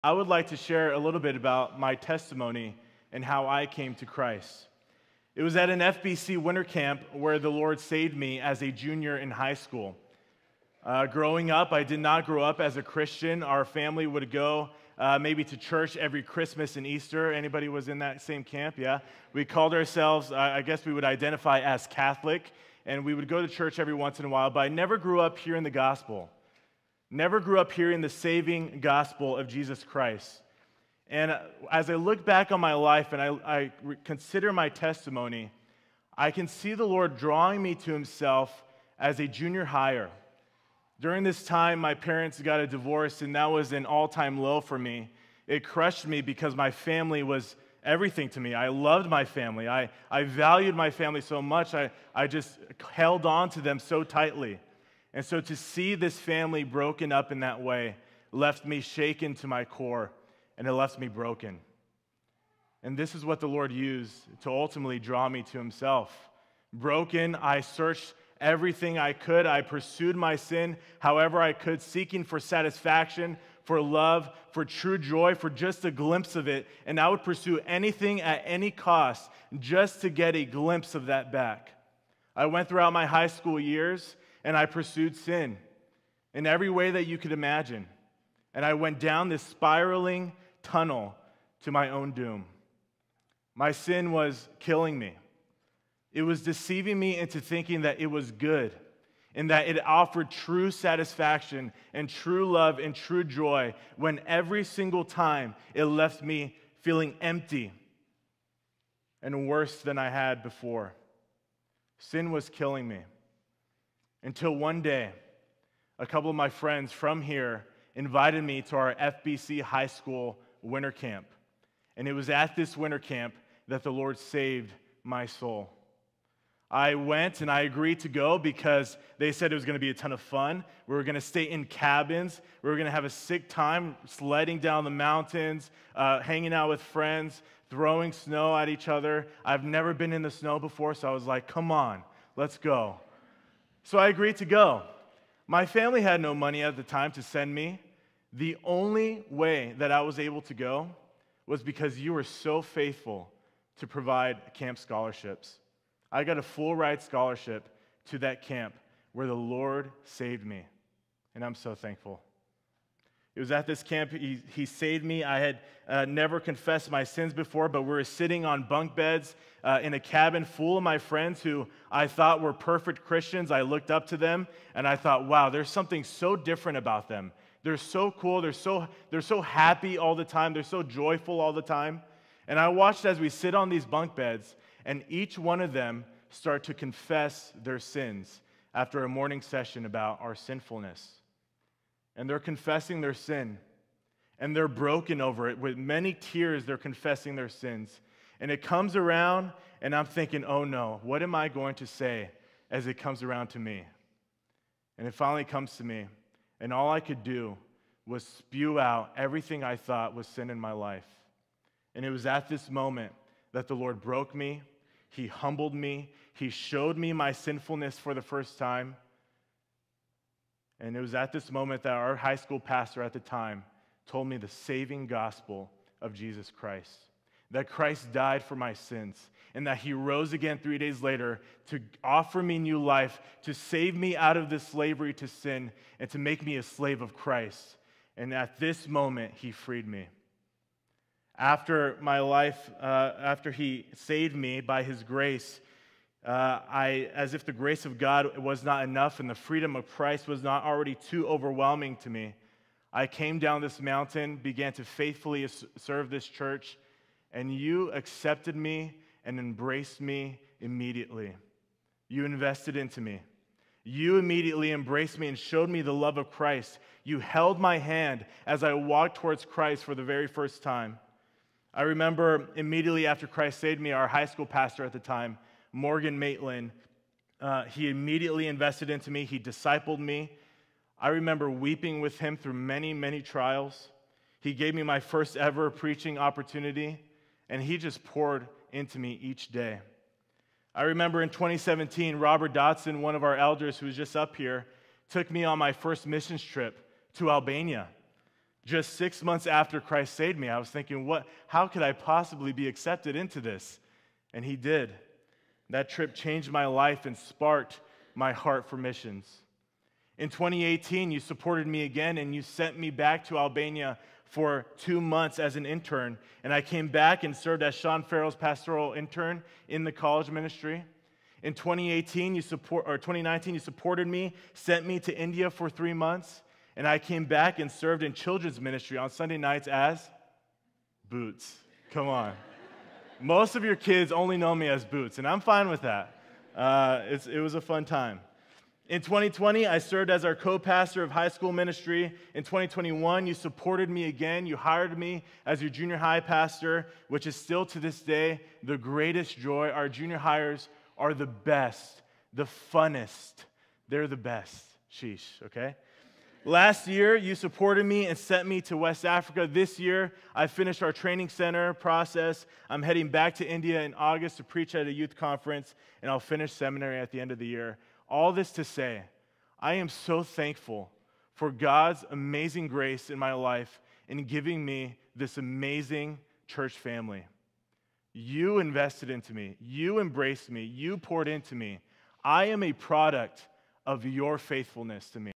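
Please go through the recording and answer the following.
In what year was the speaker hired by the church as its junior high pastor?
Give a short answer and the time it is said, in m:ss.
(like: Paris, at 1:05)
2021, at 5:42.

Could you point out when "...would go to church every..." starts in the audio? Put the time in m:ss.
0:23.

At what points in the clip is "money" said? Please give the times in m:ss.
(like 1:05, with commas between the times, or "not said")
2:26.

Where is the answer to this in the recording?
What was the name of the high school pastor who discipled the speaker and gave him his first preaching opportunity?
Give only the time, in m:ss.
4:35.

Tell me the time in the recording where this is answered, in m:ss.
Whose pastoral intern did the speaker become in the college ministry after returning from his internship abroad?
5:17.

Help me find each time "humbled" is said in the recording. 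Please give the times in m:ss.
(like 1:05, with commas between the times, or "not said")
3:35.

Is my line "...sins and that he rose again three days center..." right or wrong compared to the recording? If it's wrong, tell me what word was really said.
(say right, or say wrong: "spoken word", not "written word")
wrong: "later", not "center".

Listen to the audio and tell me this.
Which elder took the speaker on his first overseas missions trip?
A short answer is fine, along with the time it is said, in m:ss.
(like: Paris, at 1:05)
Robert Dotson, at 4:52.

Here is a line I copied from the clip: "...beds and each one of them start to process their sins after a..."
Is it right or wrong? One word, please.
wrong.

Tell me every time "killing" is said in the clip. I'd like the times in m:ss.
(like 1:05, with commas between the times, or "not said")
1:34, 1:52.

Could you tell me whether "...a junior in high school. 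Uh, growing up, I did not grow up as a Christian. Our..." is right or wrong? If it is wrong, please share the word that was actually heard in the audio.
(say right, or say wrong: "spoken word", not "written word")
right.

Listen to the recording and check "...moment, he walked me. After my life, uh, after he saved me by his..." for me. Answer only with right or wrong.
wrong.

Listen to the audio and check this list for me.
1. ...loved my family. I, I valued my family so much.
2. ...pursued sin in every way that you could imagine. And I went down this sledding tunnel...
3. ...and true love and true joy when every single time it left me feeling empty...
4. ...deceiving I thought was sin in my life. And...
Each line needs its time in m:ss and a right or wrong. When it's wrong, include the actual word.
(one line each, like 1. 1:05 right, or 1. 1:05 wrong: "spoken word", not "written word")
1. 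0:48 right
2. 1:24 wrong: "spiraling", not "sledding"
3. 1:41 right
4. 3:29 wrong: "everything", not "deceiving".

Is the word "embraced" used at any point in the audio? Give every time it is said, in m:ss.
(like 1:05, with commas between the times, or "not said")
4:19, 4:24, 6:19.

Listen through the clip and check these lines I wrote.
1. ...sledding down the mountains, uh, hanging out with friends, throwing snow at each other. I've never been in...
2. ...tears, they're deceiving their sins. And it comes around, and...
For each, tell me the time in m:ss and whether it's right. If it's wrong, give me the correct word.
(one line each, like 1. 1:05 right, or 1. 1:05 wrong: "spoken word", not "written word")
1. 2:14 right
2. 3:16 wrong: "confessing", not "deceiving".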